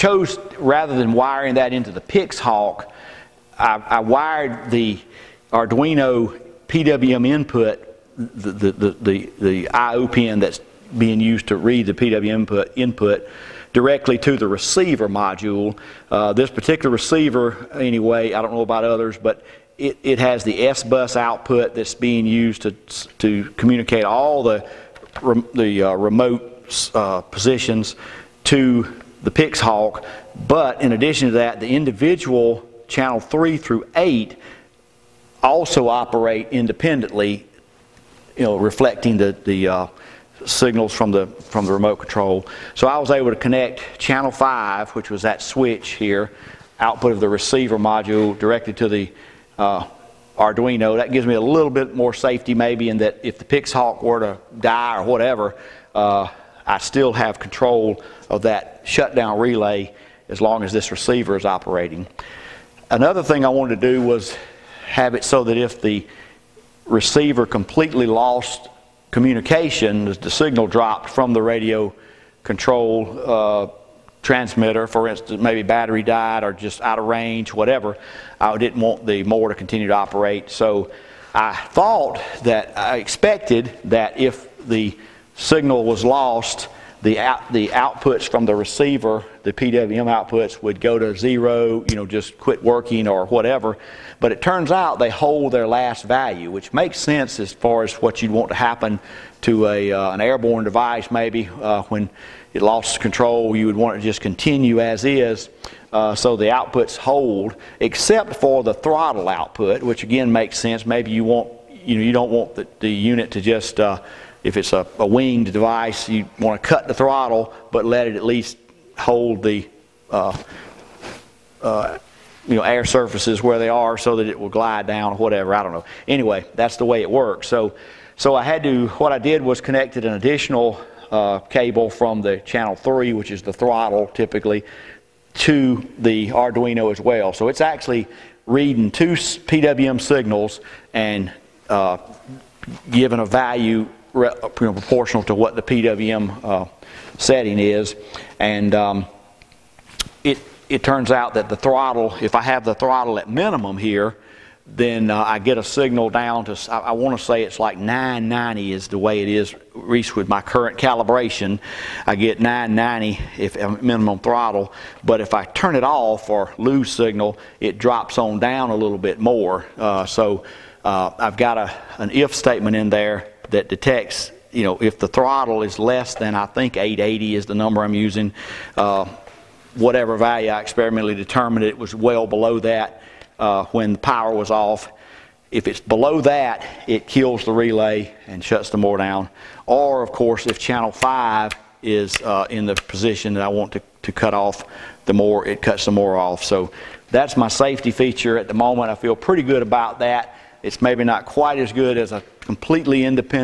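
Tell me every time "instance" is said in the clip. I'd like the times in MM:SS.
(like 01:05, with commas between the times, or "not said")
01:15.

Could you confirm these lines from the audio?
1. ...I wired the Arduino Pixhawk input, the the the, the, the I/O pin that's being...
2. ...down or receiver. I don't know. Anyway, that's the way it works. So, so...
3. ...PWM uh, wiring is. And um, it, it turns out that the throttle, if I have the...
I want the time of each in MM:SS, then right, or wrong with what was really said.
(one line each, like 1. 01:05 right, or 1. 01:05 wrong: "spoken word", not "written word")
1. 00:03 wrong: "PWM", not "Pixhawk"
2. 02:04 wrong: "whatever", not "receiver"
3. 02:25 wrong: "setting", not "wiring".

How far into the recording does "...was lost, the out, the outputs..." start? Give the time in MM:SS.
01:25.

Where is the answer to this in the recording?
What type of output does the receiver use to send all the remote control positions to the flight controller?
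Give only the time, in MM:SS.
00:20.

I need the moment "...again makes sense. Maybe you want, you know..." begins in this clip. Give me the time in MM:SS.
01:50.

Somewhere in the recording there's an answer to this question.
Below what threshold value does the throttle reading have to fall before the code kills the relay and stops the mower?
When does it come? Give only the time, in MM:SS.
02:56.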